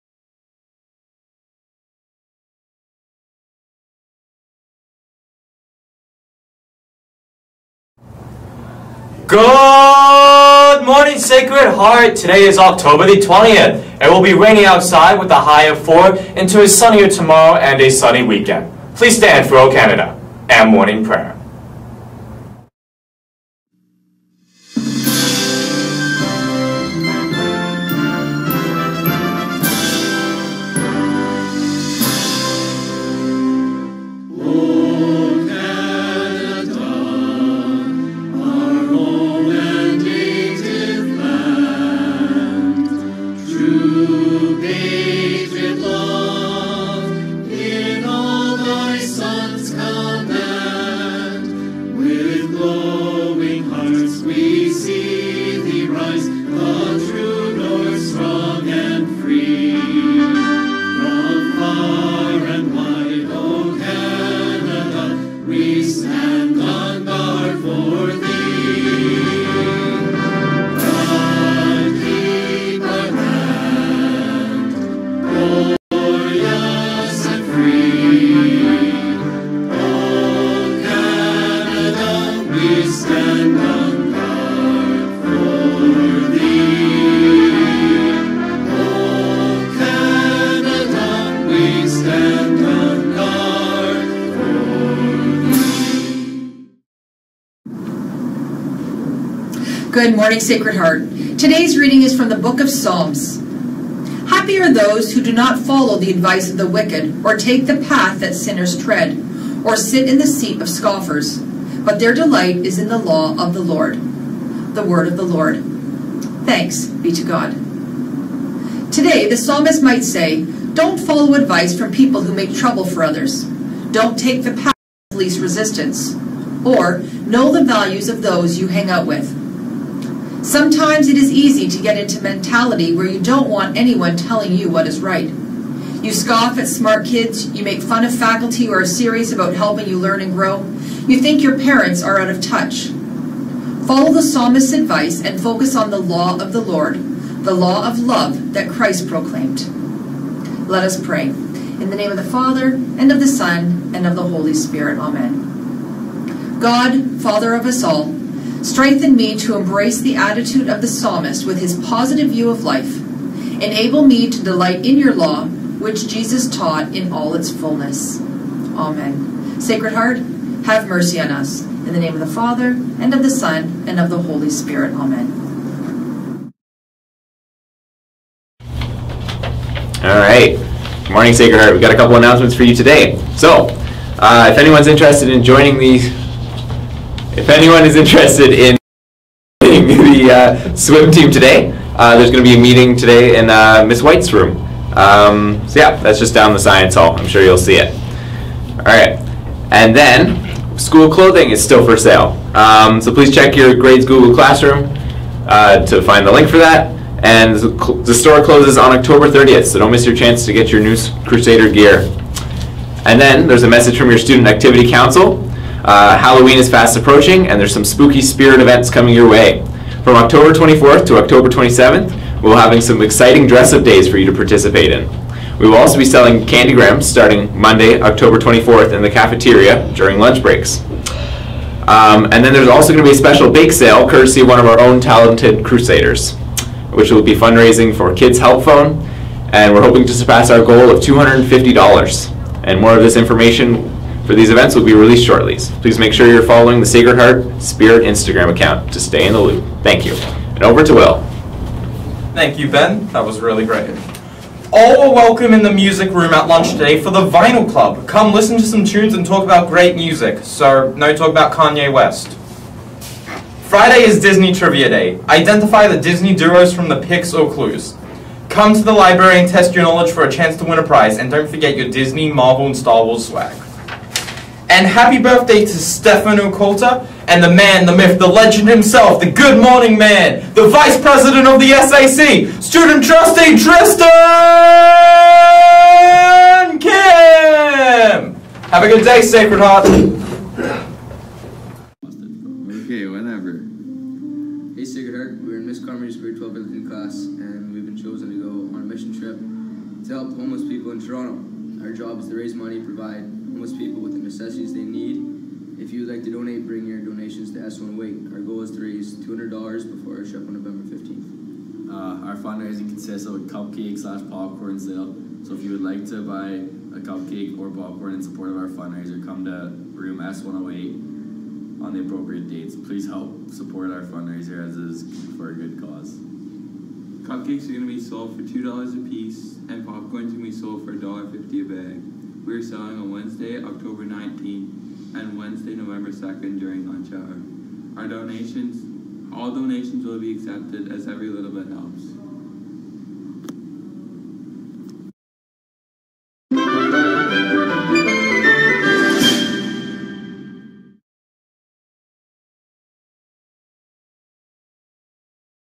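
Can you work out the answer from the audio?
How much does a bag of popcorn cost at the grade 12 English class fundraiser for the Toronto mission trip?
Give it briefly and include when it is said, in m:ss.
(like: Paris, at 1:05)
$1.50, at 5:30.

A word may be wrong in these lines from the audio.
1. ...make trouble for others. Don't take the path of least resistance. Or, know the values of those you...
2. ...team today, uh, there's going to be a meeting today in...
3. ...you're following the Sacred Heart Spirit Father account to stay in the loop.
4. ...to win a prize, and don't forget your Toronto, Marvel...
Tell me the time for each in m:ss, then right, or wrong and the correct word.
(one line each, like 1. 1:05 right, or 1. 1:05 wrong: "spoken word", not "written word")
1. 2:02 right
2. 3:11 right
3. 4:06 wrong: "Instagram", not "Father"
4. 4:30 wrong: "Disney", not "Toronto".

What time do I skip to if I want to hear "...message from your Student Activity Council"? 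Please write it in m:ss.
3:33.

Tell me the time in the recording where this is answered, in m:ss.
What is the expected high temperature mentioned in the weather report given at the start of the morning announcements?
0:15.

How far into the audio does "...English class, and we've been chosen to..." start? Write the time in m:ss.
4:56.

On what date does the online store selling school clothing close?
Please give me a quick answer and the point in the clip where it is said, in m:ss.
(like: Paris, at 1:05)
October 30th, at 3:28.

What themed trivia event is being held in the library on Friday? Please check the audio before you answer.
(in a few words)
Disney Trivia Day.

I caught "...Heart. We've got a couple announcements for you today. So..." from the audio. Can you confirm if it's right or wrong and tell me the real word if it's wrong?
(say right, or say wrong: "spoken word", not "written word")
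right.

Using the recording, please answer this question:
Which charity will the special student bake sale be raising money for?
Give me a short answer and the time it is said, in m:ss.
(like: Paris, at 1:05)
Kids Help Phone, at 3:58.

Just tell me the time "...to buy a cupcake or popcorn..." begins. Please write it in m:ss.
5:16.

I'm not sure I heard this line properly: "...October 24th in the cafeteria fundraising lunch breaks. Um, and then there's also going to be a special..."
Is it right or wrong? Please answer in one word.
wrong.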